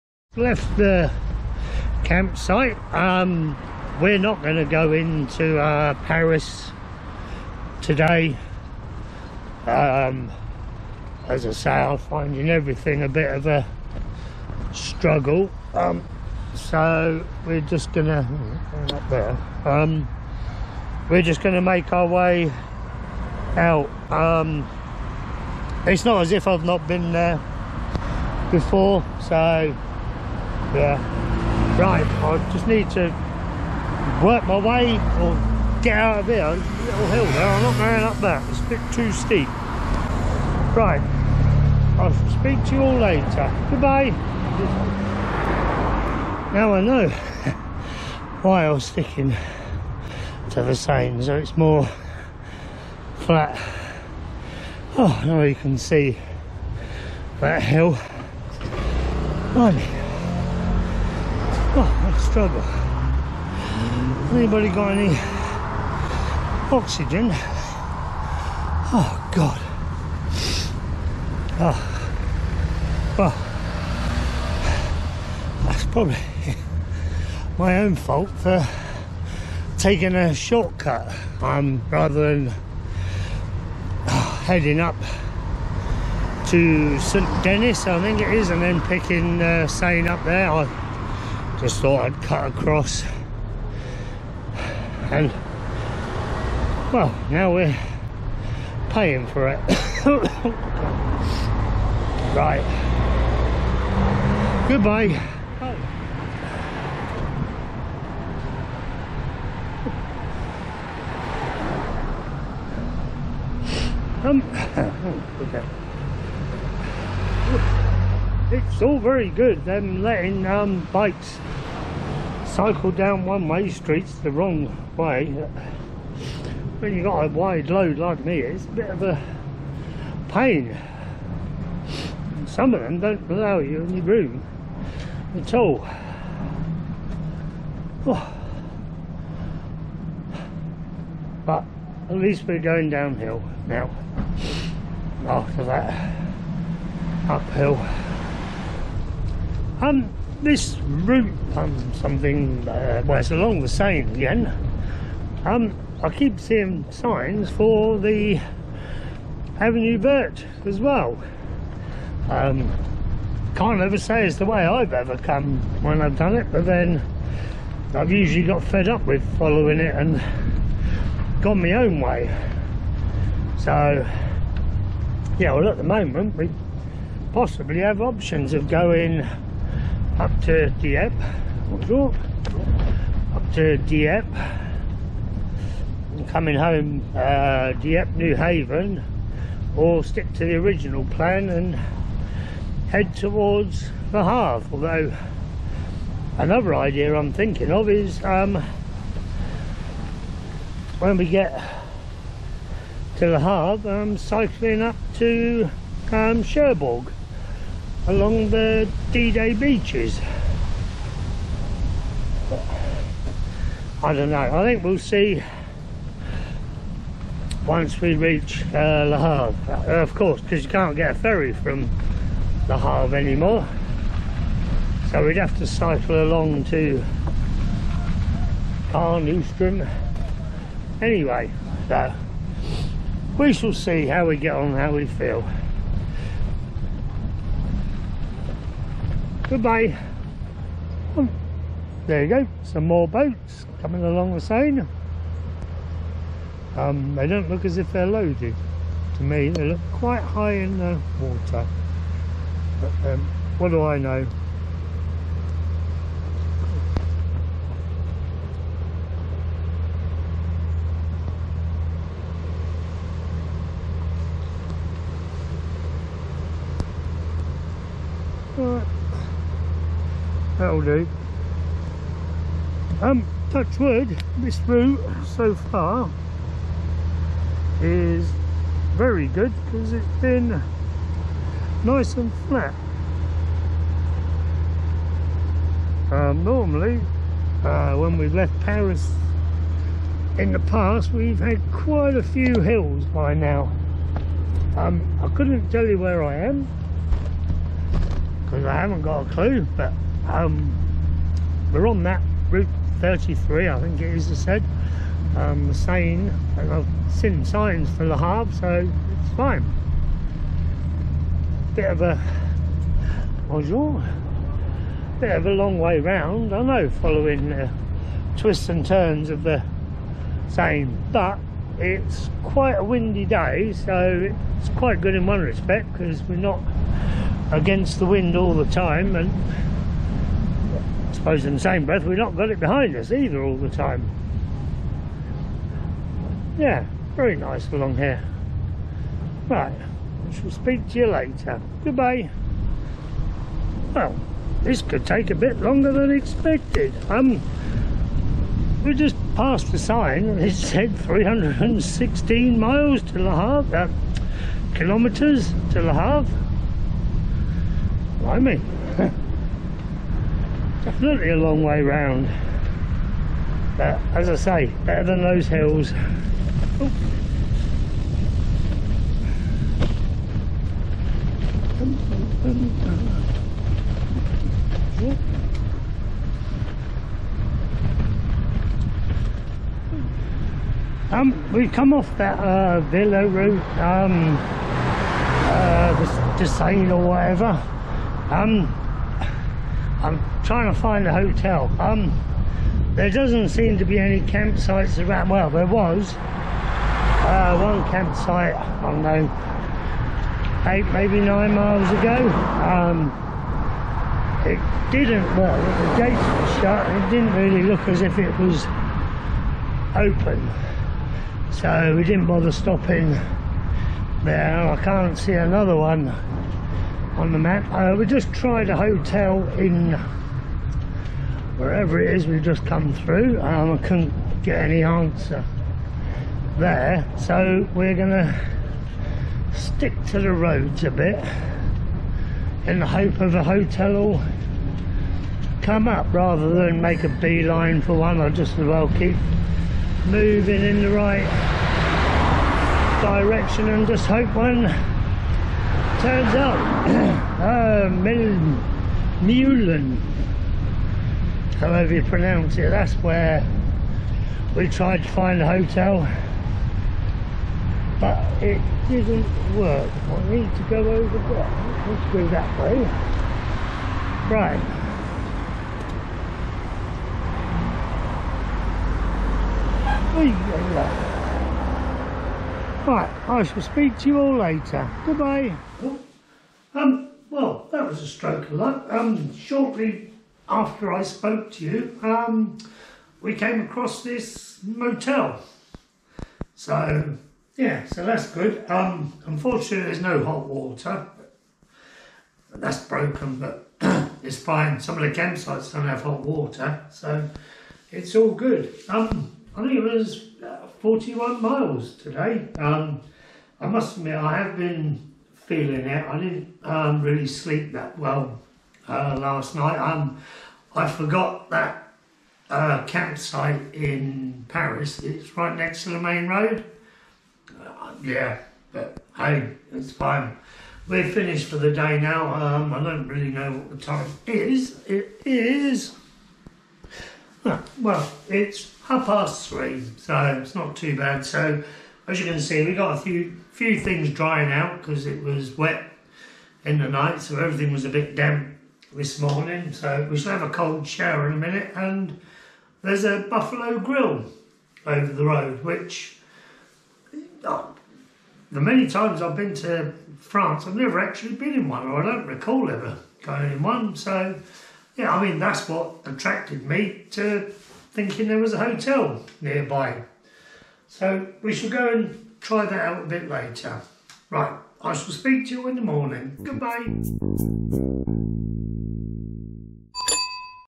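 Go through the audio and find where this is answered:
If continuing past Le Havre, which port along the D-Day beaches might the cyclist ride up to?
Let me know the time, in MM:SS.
03:26.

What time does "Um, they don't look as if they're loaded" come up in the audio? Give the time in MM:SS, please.
04:06.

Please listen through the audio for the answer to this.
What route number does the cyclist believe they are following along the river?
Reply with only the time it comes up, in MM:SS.
05:02.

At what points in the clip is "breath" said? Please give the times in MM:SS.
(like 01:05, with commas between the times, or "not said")
05:31.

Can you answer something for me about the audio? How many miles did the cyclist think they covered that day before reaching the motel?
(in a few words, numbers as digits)
41.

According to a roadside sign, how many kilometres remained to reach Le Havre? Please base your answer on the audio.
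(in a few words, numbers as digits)
316.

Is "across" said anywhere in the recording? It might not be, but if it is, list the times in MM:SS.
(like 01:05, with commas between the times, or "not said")
01:32, 08:03.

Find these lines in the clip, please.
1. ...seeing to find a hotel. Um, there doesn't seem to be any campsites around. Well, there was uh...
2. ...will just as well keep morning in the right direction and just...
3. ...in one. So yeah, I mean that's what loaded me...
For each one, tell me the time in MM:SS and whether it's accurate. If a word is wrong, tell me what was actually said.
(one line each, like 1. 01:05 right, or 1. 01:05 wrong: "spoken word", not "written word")
1. 06:30 wrong: "trying", not "seeing"
2. 07:18 wrong: "moving", not "morning"
3. 09:13 wrong: "attracted", not "loaded".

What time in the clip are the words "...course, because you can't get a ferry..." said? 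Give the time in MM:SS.
03:40.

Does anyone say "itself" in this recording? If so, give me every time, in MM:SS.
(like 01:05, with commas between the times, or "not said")
not said.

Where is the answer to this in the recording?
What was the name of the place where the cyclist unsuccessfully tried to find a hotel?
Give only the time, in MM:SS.
07:29.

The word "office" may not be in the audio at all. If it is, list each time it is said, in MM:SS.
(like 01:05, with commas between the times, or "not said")
not said.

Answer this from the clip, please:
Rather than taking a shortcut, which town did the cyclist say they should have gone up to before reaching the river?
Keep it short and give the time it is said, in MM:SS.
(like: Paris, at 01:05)
St Denis, at 01:26.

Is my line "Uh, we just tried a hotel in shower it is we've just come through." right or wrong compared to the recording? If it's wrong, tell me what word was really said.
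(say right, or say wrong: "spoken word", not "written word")
wrong: "wherever", not "shower".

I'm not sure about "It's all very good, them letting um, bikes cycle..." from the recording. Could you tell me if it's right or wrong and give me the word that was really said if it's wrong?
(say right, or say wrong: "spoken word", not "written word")
right.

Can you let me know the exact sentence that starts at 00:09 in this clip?
Um, as I say, I'm finding everything a bit of a struggle.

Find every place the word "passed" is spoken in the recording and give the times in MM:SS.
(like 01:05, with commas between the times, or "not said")
05:49.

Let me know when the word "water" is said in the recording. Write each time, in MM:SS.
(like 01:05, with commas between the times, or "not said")
04:11, 08:10, 08:16.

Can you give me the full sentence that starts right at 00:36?
little hill there, I'm not going up that.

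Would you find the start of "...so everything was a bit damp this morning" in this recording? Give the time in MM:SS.
08:57.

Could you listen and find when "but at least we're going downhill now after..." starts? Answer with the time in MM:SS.
02:21.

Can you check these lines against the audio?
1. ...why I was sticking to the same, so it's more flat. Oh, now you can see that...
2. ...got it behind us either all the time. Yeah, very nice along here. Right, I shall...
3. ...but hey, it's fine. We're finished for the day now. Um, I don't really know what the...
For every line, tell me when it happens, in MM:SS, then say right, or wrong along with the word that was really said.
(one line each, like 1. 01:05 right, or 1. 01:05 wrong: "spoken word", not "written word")
1. 00:48 right
2. 05:32 right
3. 08:38 right.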